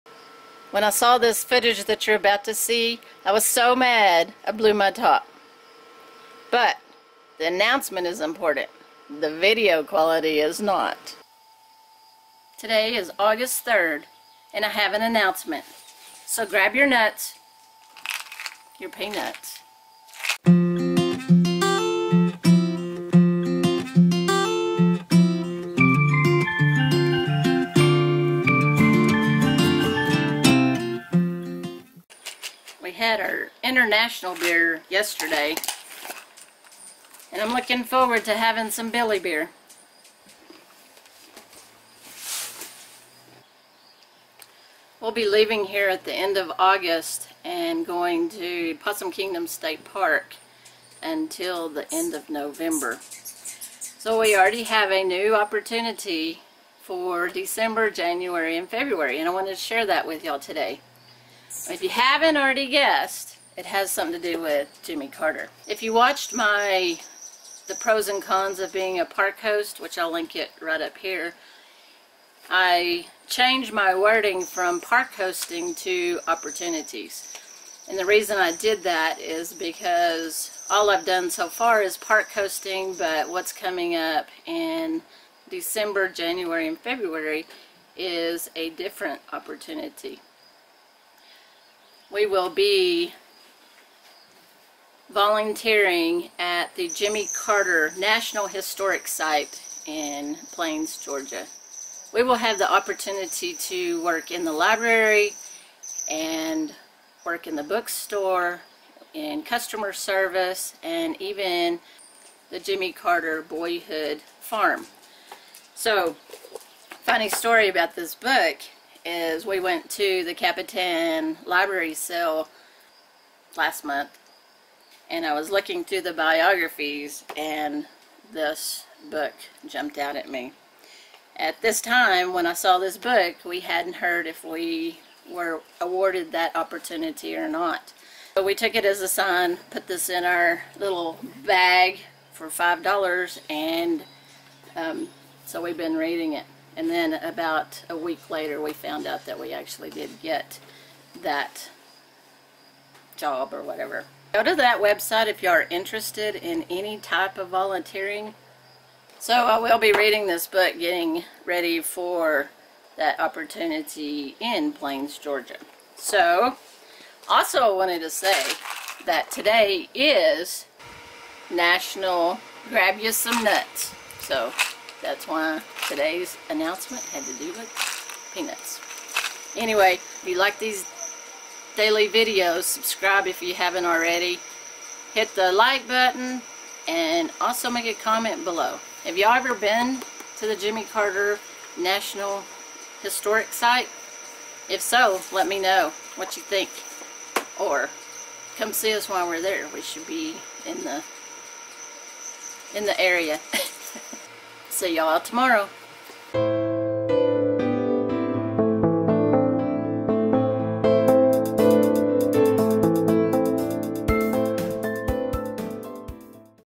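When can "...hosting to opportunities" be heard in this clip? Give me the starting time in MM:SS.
01:15.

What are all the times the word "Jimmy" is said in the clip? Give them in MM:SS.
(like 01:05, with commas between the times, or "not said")
01:04, 01:36, 01:52, 03:10.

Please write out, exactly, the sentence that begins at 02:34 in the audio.
Go to that website if you are interested in any type of volunteering.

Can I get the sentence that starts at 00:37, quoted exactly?
And I'm looking forward to having some Billy beer.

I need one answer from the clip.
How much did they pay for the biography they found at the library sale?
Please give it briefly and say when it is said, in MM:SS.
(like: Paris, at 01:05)
$5, at 02:22.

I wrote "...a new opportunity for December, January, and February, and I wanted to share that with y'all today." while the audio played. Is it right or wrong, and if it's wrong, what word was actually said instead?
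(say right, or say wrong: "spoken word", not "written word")
right.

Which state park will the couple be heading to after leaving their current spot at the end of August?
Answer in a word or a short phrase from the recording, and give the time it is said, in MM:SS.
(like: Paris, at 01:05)
Possum Kingdom State Park, at 00:48.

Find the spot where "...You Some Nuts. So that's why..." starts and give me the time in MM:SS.
02:53.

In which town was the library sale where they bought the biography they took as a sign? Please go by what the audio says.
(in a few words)
Capitan.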